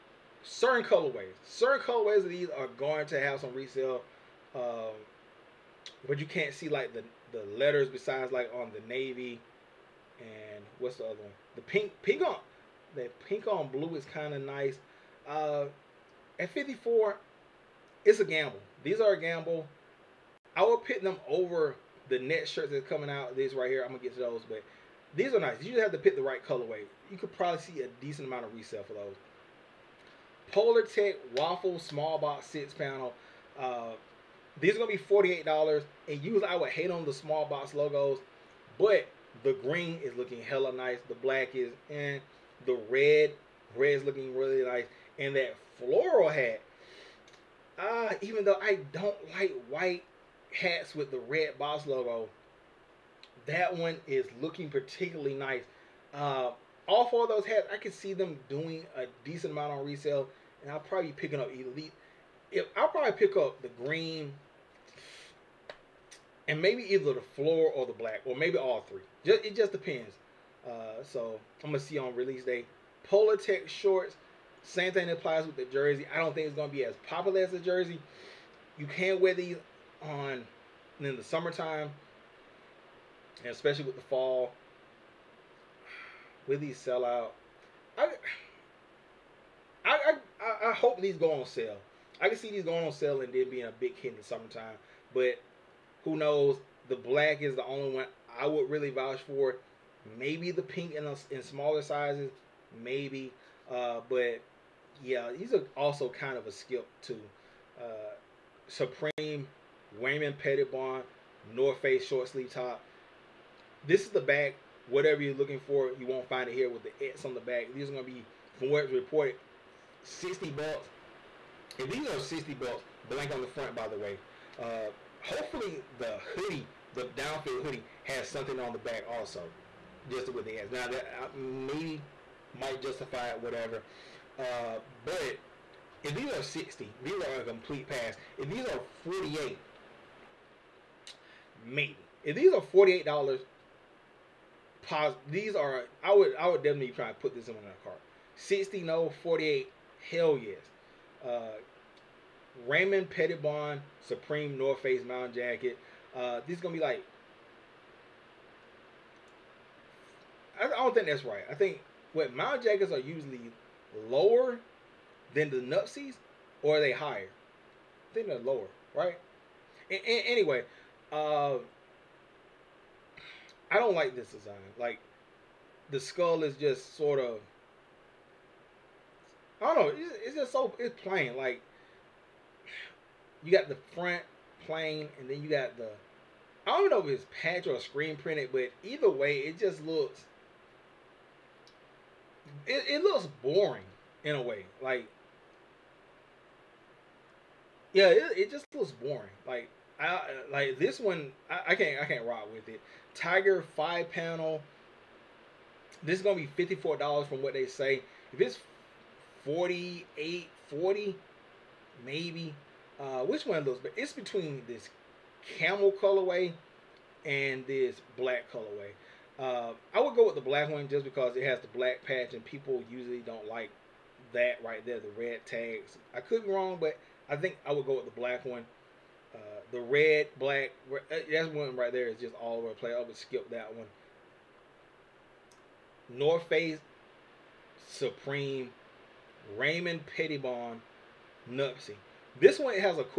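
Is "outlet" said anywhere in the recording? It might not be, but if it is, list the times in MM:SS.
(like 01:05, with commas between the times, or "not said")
not said.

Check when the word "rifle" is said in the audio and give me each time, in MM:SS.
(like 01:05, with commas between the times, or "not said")
not said.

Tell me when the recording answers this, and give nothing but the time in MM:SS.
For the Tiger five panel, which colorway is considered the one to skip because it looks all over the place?
03:49.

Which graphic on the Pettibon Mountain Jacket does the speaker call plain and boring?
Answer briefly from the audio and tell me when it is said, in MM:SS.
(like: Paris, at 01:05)
the skull, at 02:55.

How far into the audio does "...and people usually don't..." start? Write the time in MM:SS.
03:42.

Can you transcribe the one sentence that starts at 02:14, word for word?
Uh, but if these are 60, these are a complete pass.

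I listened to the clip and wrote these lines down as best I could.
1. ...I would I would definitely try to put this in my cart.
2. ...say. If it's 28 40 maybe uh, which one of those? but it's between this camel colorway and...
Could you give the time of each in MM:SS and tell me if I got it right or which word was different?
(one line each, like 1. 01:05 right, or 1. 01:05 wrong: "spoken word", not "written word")
1. 02:26 right
2. 03:27 wrong: "48", not "28".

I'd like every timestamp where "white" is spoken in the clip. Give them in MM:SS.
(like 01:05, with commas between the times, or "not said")
00:49.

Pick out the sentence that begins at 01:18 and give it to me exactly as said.
You can wear these on in the summertime, and especially with the fall.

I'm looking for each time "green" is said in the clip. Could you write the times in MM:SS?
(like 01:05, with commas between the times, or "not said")
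00:39, 01:03.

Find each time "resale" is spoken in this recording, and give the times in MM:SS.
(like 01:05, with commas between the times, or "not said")
00:03, 00:28, 00:59.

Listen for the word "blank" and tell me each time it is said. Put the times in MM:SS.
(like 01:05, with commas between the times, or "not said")
02:03.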